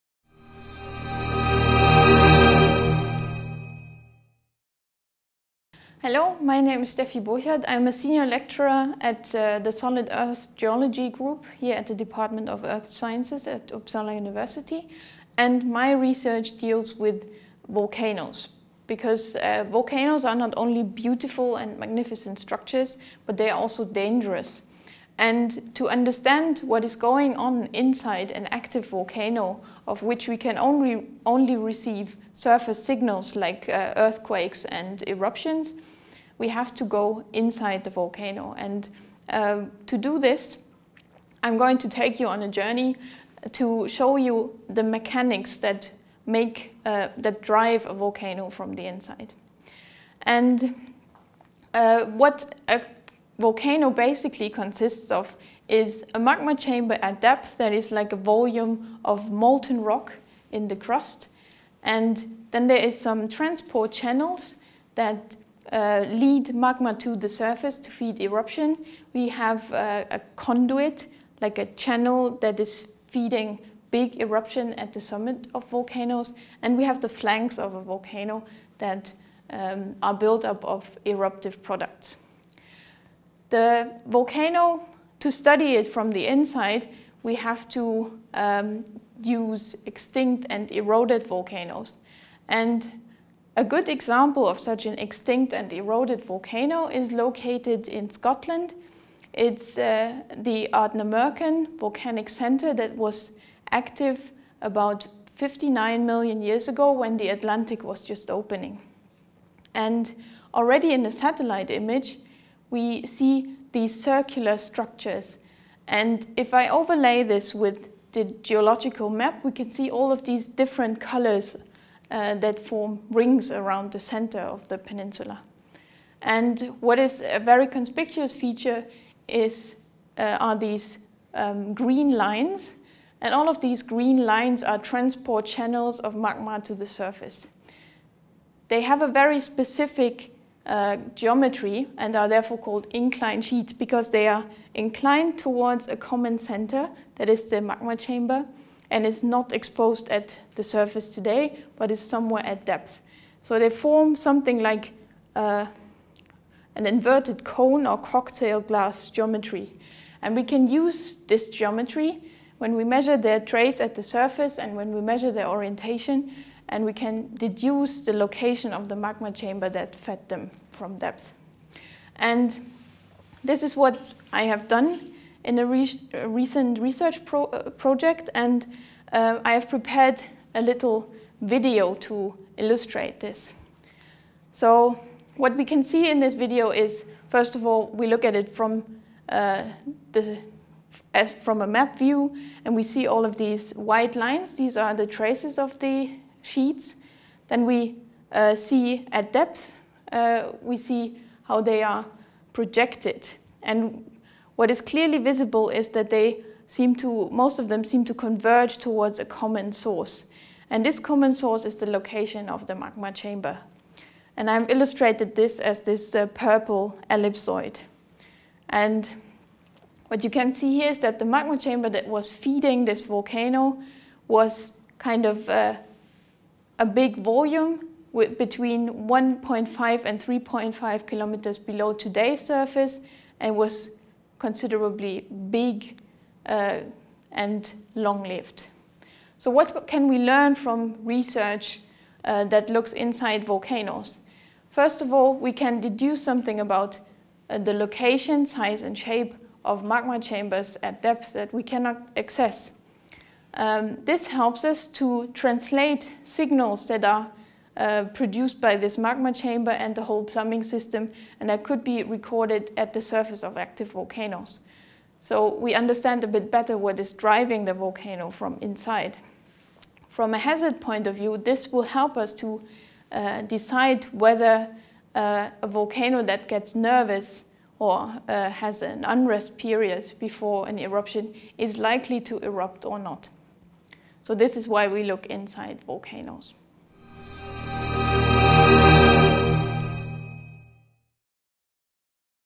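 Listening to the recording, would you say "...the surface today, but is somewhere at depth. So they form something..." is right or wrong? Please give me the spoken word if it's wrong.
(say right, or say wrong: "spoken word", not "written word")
right.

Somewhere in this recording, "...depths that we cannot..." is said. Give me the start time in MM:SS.
04:11.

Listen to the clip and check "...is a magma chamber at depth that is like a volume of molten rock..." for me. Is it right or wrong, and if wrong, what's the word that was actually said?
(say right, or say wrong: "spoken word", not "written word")
right.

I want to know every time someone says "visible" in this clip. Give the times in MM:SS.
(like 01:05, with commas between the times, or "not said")
03:25.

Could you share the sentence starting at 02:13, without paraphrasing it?
And all of these green lines are transport channels of magma to the surface.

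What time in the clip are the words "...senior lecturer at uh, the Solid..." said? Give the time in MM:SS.
00:07.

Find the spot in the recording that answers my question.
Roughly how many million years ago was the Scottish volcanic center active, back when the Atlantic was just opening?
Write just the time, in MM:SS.
01:45.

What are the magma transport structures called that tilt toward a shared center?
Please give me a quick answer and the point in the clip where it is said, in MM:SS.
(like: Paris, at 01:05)
inclined sheets, at 02:22.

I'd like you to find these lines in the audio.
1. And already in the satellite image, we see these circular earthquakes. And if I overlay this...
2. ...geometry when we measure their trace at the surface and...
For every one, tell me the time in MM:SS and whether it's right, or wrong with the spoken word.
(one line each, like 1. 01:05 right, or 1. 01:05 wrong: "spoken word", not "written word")
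1. 01:49 wrong: "structures", not "earthquakes"
2. 02:41 right.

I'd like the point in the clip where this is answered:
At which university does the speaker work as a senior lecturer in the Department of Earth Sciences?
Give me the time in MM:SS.
00:13.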